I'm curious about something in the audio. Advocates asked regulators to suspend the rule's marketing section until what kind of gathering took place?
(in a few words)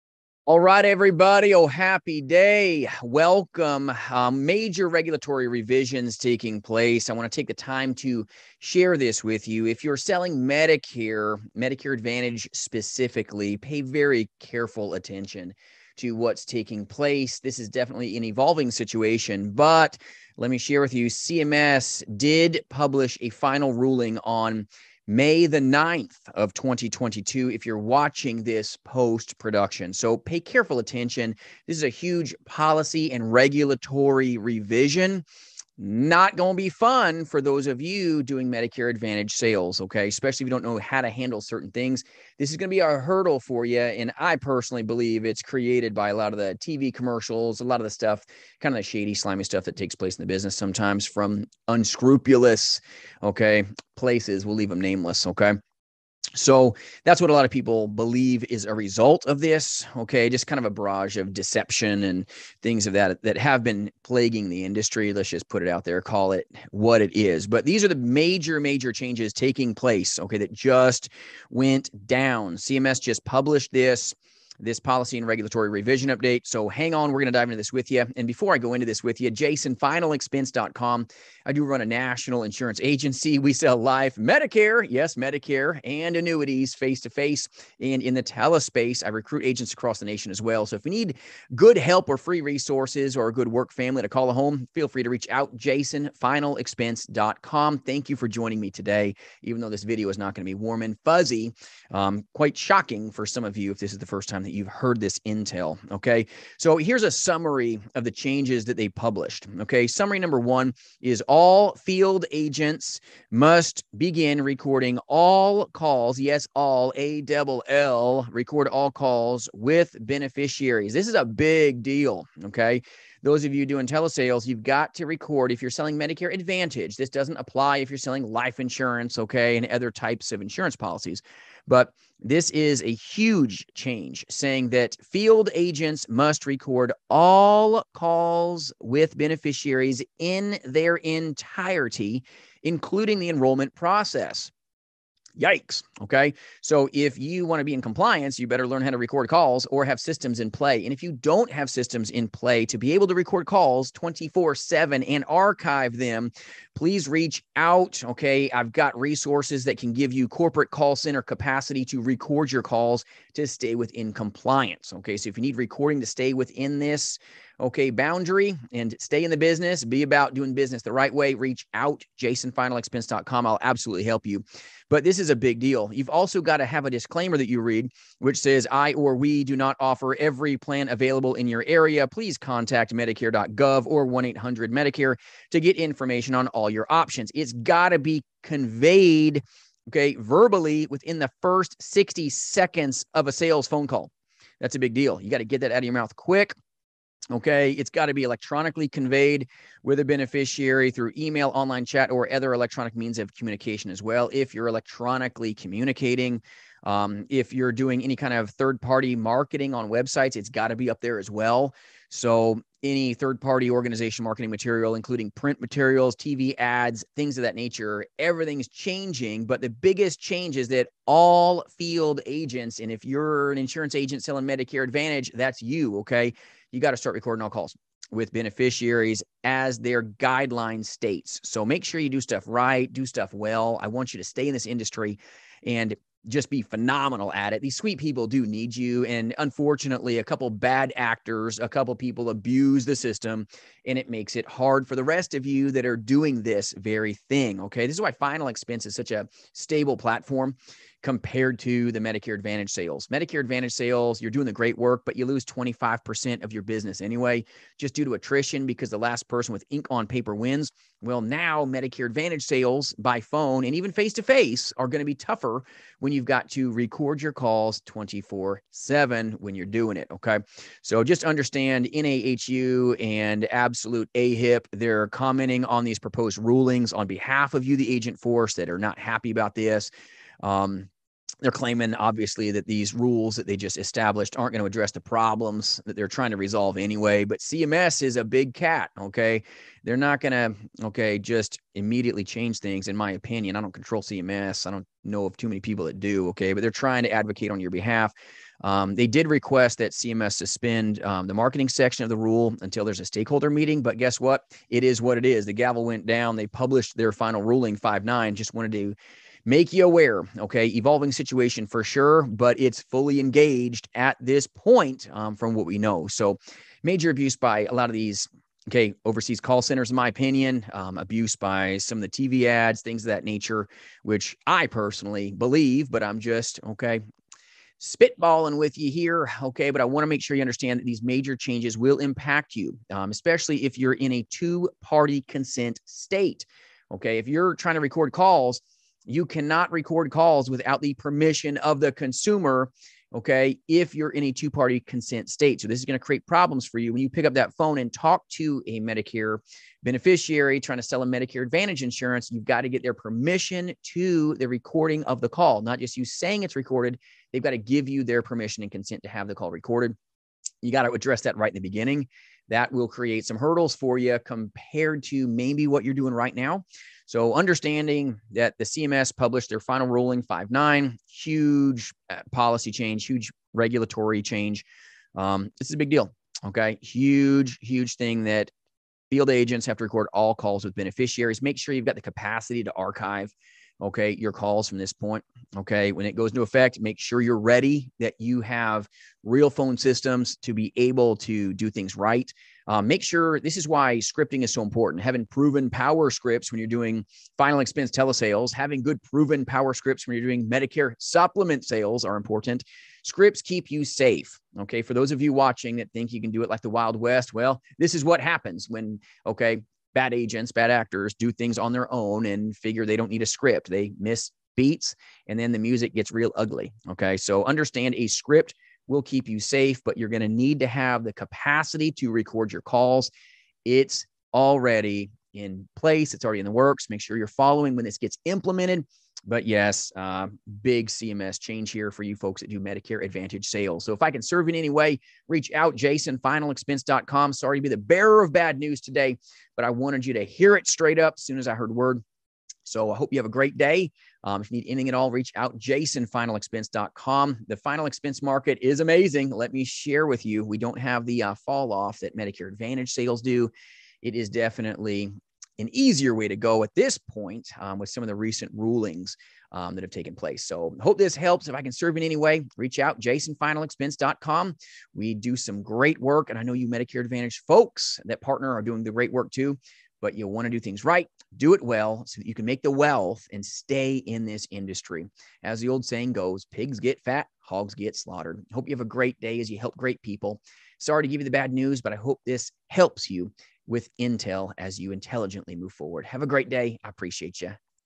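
stakeholder meeting.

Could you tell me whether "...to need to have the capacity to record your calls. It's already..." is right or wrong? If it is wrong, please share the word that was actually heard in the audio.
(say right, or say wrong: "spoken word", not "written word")
right.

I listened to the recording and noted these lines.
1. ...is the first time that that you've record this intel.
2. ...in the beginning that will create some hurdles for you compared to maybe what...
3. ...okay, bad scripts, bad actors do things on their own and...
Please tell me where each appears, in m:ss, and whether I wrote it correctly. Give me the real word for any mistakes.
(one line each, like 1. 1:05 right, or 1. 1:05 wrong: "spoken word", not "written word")
1. 1:43 wrong: "heard", not "record"
2. 6:01 right
3. 6:49 wrong: "agents", not "scripts".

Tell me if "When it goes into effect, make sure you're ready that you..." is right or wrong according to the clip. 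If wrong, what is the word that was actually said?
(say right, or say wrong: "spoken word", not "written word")
right.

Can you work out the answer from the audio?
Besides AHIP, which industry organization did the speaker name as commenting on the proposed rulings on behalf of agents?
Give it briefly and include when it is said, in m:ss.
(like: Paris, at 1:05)
NAHU, at 4:31.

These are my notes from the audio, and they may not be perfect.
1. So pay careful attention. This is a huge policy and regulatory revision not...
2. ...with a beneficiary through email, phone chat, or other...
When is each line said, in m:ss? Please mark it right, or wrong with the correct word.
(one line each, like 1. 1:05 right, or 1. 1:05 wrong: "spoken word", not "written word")
1. 0:29 right
2. 3:19 wrong: "online", not "phone".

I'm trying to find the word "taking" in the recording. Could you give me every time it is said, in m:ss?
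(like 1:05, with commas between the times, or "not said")
0:06, 0:16, 1:09.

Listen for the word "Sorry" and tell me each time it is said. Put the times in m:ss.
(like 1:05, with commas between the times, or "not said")
7:17, 8:00.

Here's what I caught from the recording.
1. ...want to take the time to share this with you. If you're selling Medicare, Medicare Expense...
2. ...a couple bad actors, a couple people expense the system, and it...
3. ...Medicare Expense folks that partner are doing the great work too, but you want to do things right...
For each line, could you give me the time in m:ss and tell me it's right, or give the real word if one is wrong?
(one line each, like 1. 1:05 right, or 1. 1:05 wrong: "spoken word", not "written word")
1. 0:07 wrong: "Advantage", not "Expense"
2. 4:00 wrong: "abuse", not "expense"
3. 7:46 wrong: "Advantage", not "Expense".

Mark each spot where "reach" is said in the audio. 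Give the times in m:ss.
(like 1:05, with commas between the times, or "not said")
1:35, 2:37, 2:51, 7:15, 7:25, 7:42.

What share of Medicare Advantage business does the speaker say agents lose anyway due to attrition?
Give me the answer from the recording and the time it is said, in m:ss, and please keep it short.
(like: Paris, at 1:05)
25%, at 4:15.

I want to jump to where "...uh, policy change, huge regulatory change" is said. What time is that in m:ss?
6:12.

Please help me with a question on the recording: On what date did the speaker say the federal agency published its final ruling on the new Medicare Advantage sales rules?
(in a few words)
May 9, 2022.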